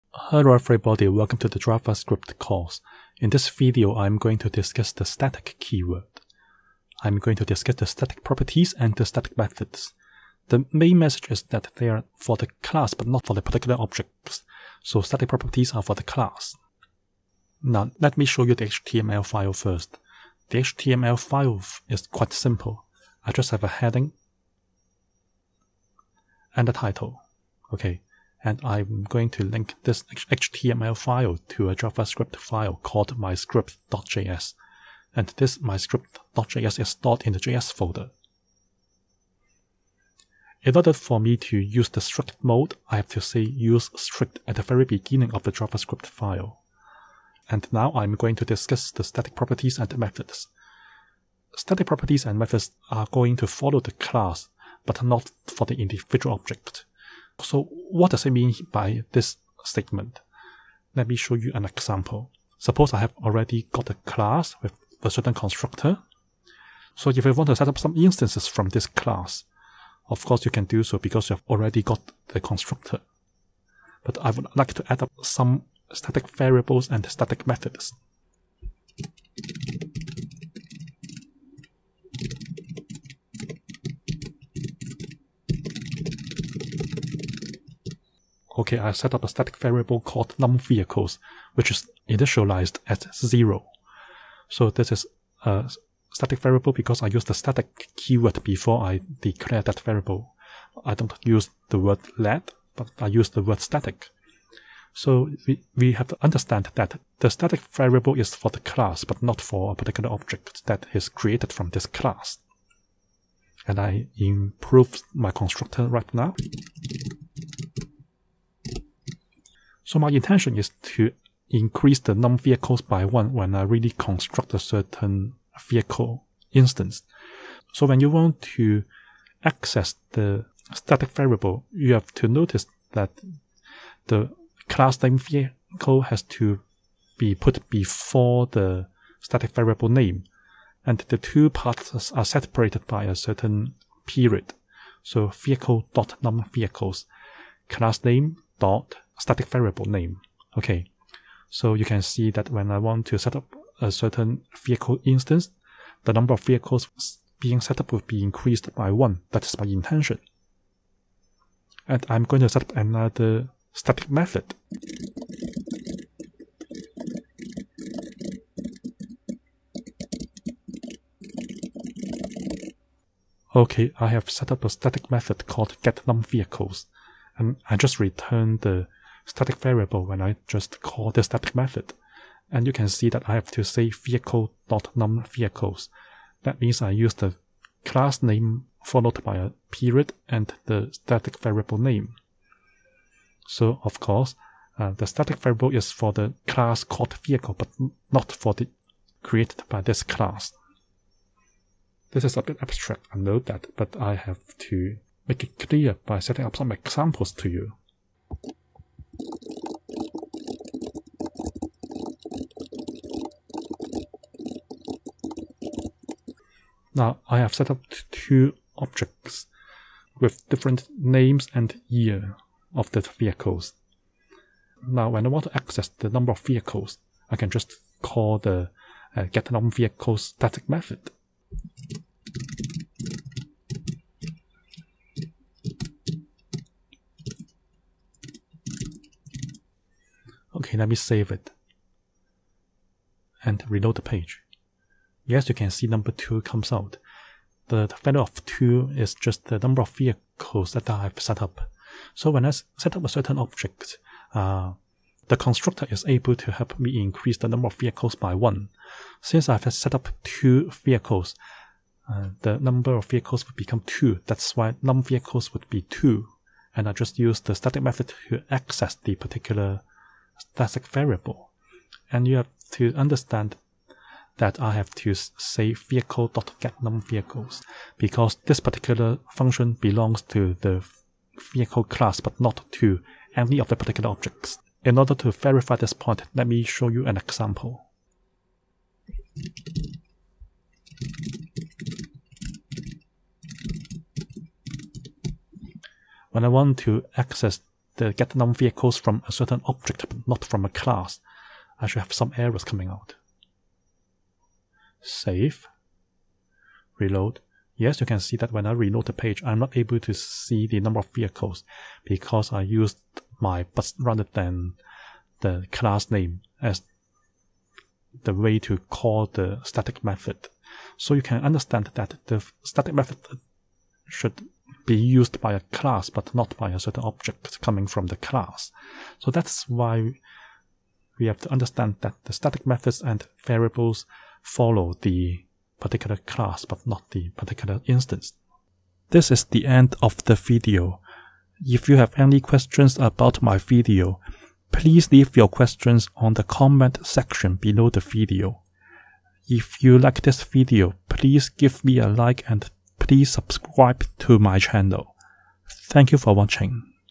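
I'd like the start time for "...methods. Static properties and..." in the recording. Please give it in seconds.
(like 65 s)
49 s.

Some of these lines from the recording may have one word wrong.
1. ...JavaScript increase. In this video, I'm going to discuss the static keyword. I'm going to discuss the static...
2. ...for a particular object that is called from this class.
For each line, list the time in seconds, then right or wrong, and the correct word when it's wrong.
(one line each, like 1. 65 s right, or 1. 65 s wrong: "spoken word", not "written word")
1. 1 s wrong: "course", not "increase"
2. 109 s wrong: "created", not "called".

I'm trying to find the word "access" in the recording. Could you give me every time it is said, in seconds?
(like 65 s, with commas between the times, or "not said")
129 s, 225 s, 268 s, 297 s.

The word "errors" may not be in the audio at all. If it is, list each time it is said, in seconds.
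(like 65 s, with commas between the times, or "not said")
302 s.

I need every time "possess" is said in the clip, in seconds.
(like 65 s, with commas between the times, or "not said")
not said.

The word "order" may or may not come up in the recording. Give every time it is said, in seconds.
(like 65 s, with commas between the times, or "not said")
40 s, 284 s.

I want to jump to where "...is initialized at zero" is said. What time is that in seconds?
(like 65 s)
91 s.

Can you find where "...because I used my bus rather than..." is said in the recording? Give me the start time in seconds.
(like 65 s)
312 s.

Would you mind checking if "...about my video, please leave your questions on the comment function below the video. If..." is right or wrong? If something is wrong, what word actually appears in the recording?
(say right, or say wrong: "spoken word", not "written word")
wrong: "section", not "function".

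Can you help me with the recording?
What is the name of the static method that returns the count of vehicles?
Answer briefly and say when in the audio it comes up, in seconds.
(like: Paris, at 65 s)
getNumVehicles, at 175 s.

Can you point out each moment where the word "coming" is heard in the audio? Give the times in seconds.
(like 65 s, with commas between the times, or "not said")
302 s, 327 s.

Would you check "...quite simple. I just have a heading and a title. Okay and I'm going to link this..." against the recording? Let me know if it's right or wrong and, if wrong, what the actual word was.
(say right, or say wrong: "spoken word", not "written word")
right.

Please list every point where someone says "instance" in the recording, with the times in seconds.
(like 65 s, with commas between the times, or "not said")
67 s, 126 s, 155 s, 337 s.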